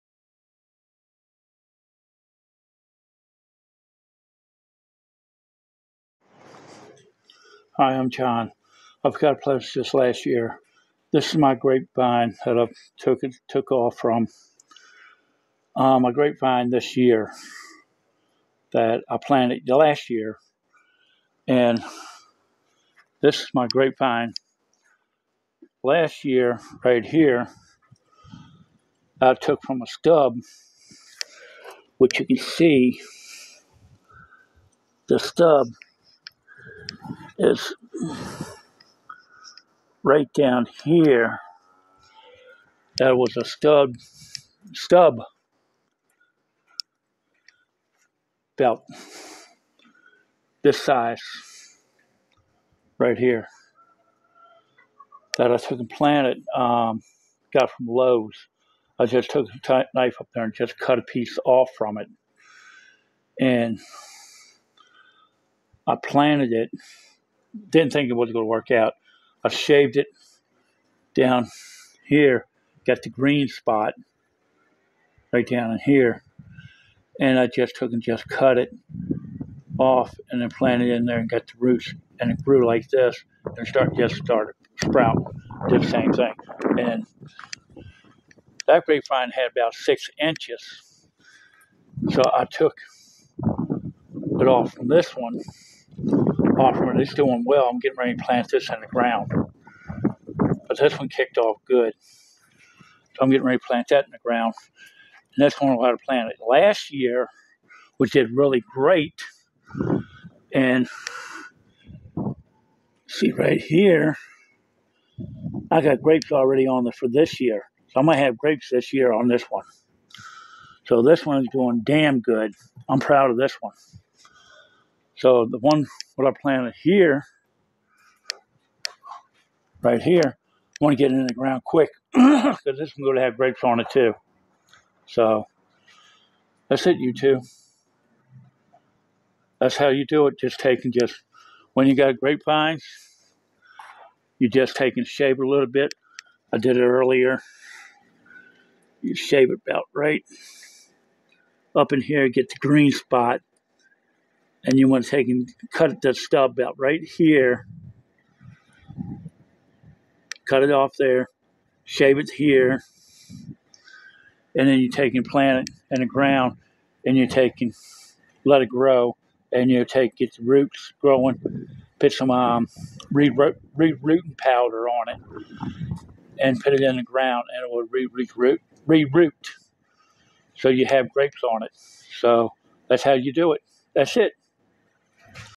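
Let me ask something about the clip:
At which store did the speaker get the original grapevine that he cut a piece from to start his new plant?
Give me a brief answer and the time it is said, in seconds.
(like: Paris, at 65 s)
Lowe's, at 57 s.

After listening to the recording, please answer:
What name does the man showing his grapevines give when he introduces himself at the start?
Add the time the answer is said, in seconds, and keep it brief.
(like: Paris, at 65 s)
John, at 8 s.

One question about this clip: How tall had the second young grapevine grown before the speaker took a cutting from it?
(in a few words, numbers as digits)
6 inches.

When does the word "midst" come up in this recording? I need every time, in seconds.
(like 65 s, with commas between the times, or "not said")
not said.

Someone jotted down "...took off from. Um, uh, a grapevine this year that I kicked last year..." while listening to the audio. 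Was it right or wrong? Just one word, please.
wrong.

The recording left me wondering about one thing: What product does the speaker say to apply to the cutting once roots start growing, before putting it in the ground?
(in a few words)
re-rooting powder.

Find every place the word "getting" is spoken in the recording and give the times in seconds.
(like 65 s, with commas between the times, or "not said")
97 s, 103 s.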